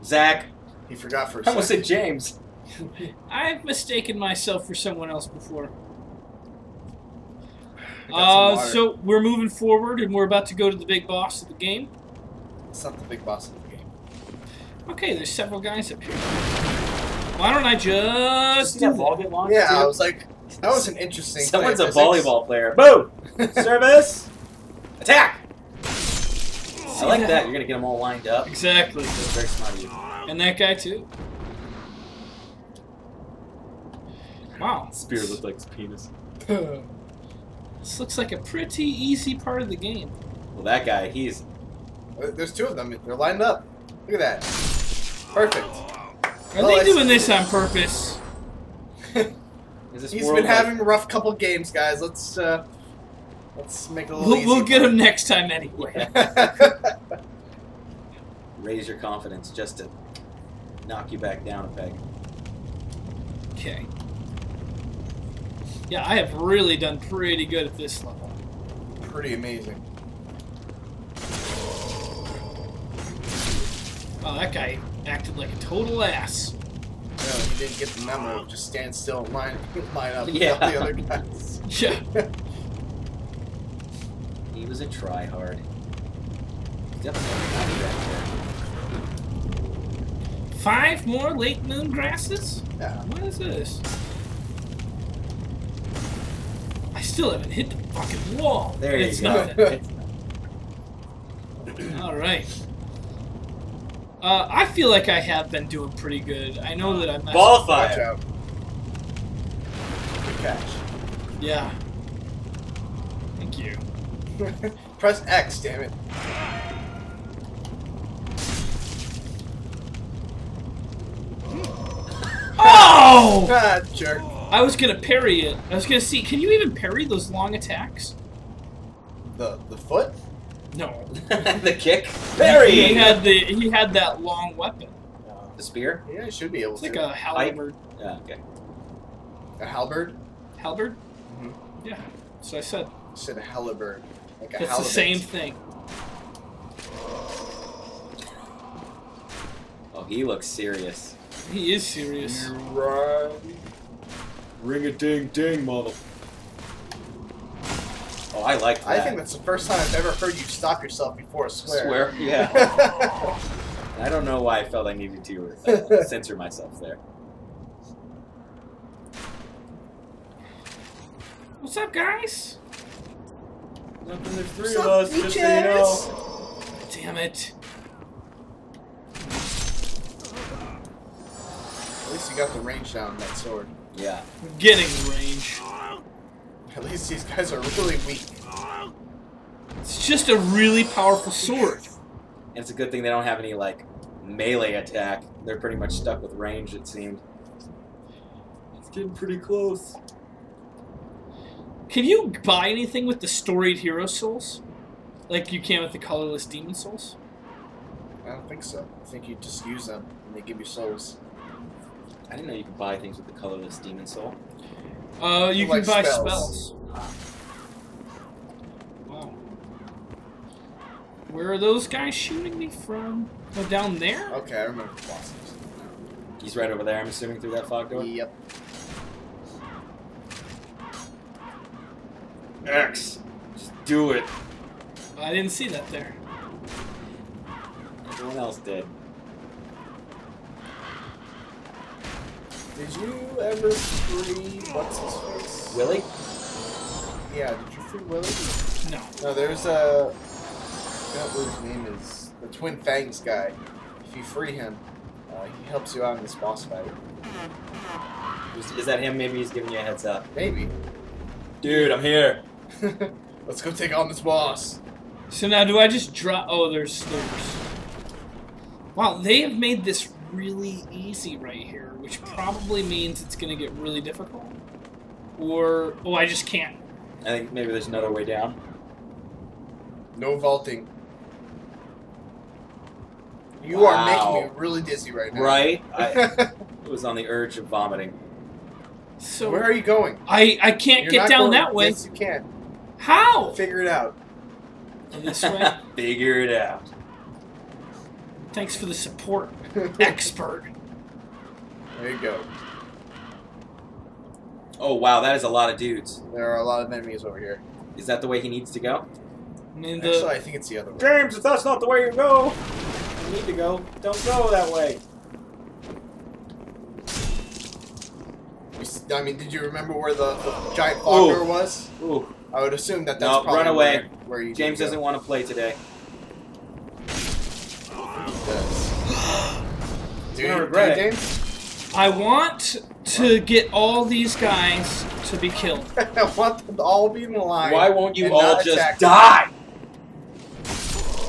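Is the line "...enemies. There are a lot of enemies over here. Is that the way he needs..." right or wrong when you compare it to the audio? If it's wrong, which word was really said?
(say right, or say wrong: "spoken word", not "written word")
wrong: "dudes", not "enemies".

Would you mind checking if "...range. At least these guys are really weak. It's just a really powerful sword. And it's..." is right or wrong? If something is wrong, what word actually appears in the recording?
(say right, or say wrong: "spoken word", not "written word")
right.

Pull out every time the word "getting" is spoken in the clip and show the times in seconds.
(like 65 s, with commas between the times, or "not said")
184 s, 198 s.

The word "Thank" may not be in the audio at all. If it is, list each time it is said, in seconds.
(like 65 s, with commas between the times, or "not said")
113 s, 298 s.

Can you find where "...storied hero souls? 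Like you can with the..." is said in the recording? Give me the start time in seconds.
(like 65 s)
203 s.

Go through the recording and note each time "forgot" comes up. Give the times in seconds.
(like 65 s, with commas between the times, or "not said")
0 s, 251 s.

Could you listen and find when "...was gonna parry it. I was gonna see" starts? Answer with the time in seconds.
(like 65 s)
124 s.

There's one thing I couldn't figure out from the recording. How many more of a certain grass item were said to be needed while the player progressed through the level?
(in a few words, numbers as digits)
5.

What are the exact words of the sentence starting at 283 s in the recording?
are making me really dizzy right now.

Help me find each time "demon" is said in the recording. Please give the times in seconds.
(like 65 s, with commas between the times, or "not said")
206 s, 213 s.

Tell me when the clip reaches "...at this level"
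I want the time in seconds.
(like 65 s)
67 s.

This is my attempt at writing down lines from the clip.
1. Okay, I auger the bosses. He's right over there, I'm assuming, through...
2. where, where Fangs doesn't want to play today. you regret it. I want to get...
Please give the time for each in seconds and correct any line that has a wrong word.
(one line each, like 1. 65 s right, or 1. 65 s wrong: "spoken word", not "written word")
1. 224 s wrong: "remember", not "auger"
2. 324 s wrong: "James", not "Fangs".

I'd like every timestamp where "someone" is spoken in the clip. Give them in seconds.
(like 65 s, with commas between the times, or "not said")
4 s, 21 s.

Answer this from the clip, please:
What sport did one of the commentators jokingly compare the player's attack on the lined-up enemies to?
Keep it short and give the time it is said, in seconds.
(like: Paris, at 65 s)
Volleyball, at 21 s.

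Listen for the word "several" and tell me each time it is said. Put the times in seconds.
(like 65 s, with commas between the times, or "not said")
15 s.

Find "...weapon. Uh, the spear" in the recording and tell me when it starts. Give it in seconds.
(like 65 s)
134 s.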